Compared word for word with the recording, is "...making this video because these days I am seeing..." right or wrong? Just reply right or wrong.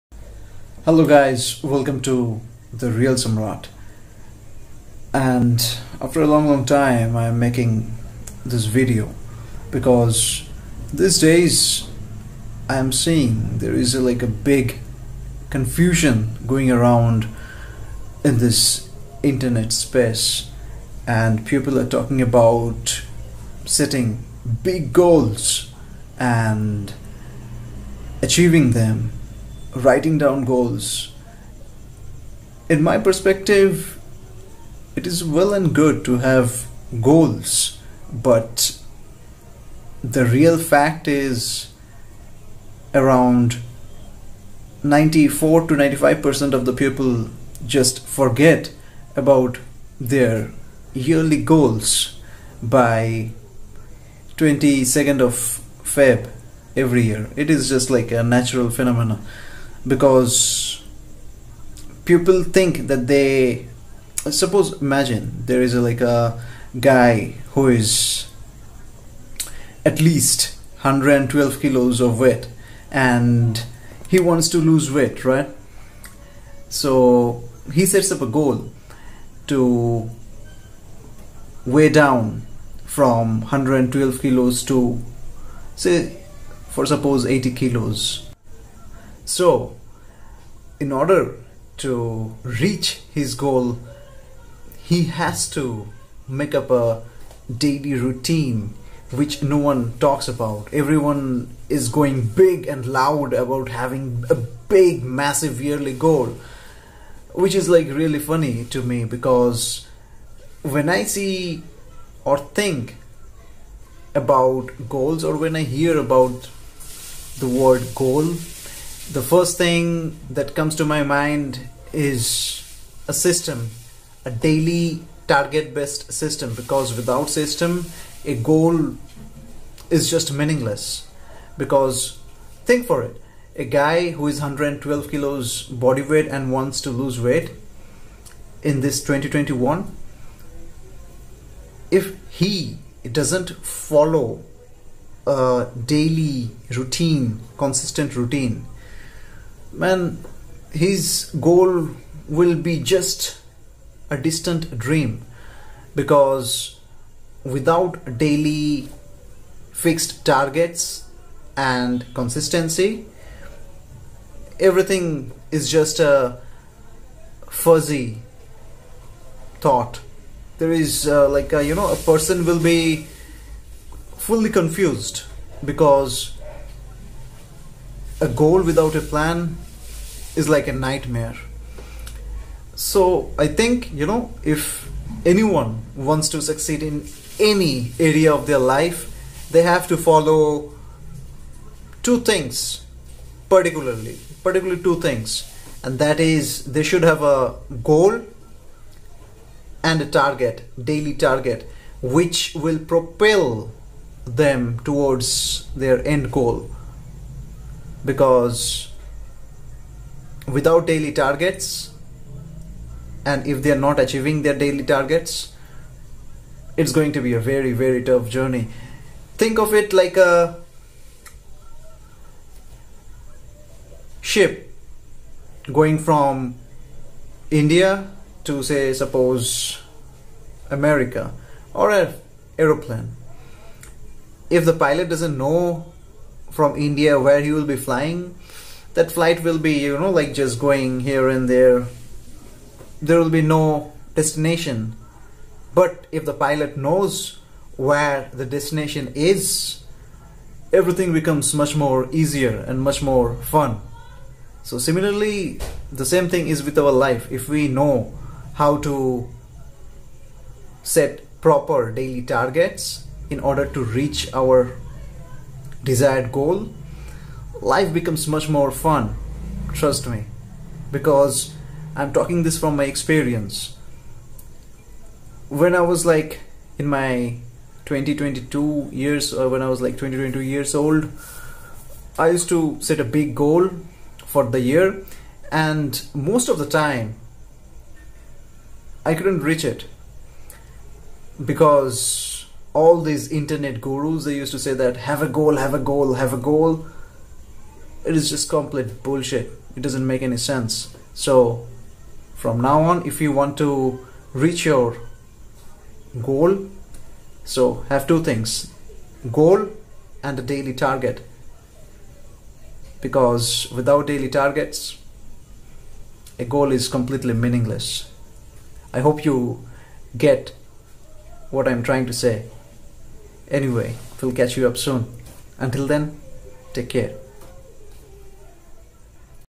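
right.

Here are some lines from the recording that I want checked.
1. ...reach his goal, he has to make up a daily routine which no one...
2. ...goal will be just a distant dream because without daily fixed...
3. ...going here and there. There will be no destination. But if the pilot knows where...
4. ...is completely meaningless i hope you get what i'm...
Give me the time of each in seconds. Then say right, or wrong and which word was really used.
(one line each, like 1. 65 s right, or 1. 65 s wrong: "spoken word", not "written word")
1. 92 s right
2. 151 s right
3. 240 s right
4. 316 s right.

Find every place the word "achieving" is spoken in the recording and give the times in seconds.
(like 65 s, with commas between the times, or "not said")
28 s, 213 s.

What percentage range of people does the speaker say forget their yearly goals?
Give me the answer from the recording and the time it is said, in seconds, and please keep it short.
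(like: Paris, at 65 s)
94 to 95%, at 44 s.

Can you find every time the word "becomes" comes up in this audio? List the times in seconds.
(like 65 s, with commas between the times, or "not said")
251 s, 267 s.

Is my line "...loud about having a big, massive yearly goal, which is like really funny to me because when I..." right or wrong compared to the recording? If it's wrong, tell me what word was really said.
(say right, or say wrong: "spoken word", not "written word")
right.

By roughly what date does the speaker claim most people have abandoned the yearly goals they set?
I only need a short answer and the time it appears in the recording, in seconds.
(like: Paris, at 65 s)
22nd of Feb, at 54 s.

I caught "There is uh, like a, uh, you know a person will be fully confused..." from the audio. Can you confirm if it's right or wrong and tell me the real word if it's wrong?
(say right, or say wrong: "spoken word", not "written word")
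right.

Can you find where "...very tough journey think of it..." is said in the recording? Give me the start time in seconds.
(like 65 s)
217 s.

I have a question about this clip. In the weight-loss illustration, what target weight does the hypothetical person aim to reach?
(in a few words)
80 kilos.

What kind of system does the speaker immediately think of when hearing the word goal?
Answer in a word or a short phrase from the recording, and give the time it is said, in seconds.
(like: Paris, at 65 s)
daily target based system, at 124 s.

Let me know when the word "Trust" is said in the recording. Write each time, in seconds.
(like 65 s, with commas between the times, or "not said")
269 s.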